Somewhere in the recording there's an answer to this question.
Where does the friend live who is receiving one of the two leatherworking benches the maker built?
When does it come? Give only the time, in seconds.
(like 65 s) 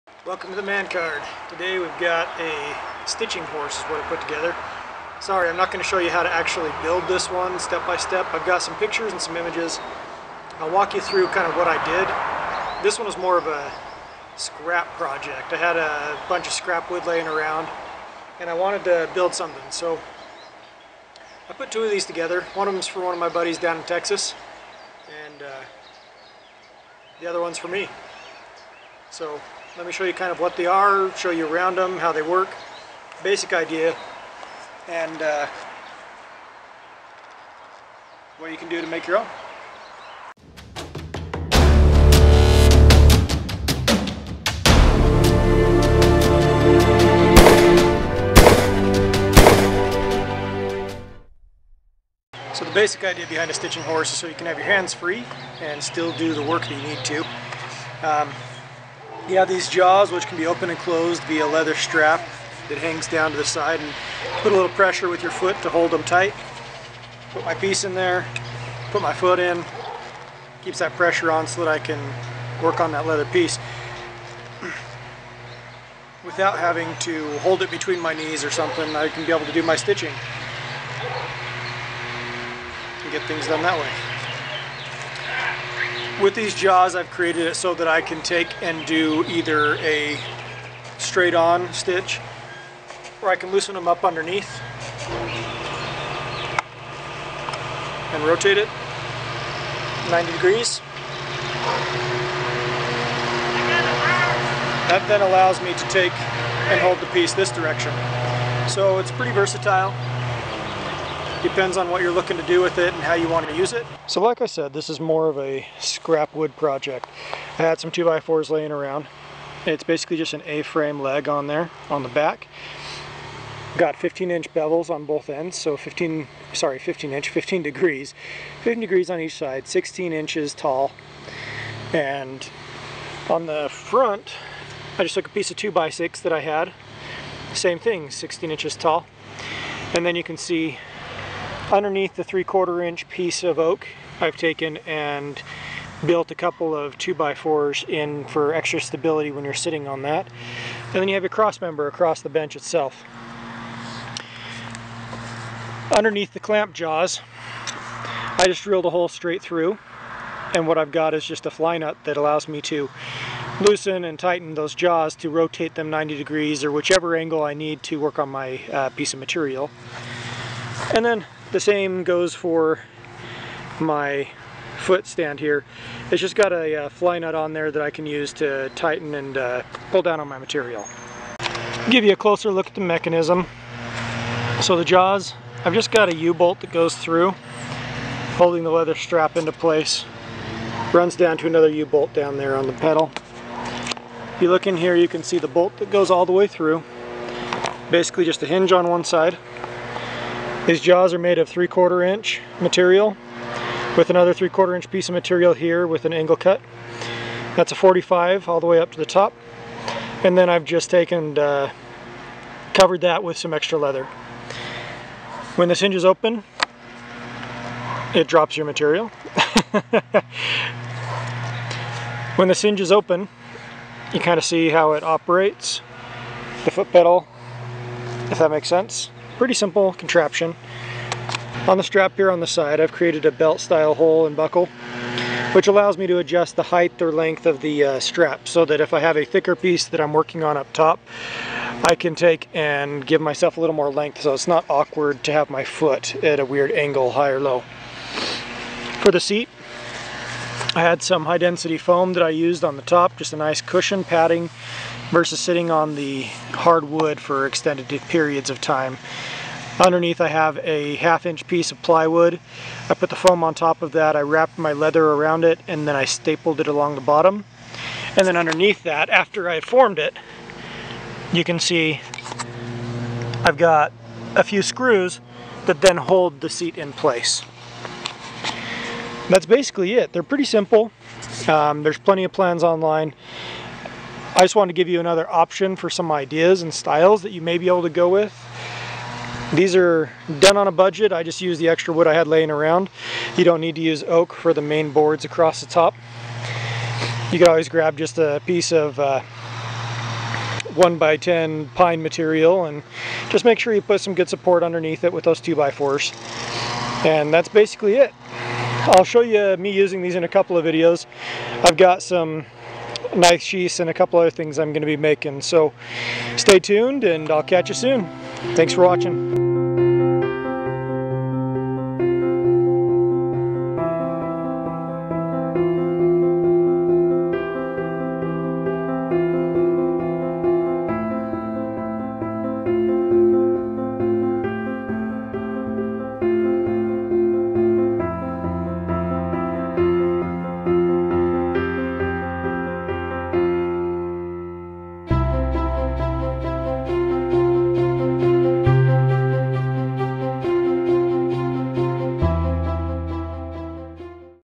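23 s.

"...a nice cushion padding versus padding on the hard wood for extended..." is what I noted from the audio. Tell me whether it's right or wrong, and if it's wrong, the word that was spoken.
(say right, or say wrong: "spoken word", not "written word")
wrong: "sitting", not "padding".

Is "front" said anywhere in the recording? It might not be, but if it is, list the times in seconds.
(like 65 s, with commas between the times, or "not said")
133 s.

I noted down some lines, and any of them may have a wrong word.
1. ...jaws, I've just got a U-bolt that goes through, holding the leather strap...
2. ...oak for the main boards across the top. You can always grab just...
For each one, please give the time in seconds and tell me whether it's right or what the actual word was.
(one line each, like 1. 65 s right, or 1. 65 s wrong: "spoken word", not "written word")
1. 184 s right
2. 294 s right.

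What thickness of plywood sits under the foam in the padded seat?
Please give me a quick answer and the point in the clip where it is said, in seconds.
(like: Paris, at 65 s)
Half inch, at 260 s.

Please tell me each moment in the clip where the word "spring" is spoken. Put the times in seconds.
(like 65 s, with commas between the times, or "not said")
not said.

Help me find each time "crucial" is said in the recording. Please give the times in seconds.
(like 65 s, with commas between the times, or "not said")
not said.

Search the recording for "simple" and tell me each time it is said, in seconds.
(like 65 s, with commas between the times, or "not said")
229 s, 280 s.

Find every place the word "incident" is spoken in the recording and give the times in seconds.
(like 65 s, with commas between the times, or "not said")
not said.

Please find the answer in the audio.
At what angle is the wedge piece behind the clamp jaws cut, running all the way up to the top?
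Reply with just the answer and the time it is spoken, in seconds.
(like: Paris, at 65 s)
45 degrees, at 207 s.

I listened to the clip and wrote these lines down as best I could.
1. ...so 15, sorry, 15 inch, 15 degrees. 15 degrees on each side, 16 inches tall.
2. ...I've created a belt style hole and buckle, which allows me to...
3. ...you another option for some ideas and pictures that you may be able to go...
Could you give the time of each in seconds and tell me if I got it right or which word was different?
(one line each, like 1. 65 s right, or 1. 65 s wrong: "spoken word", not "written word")
1. 125 s right
2. 232 s right
3. 284 s wrong: "styles", not "pictures".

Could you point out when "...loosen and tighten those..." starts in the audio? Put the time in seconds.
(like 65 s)
163 s.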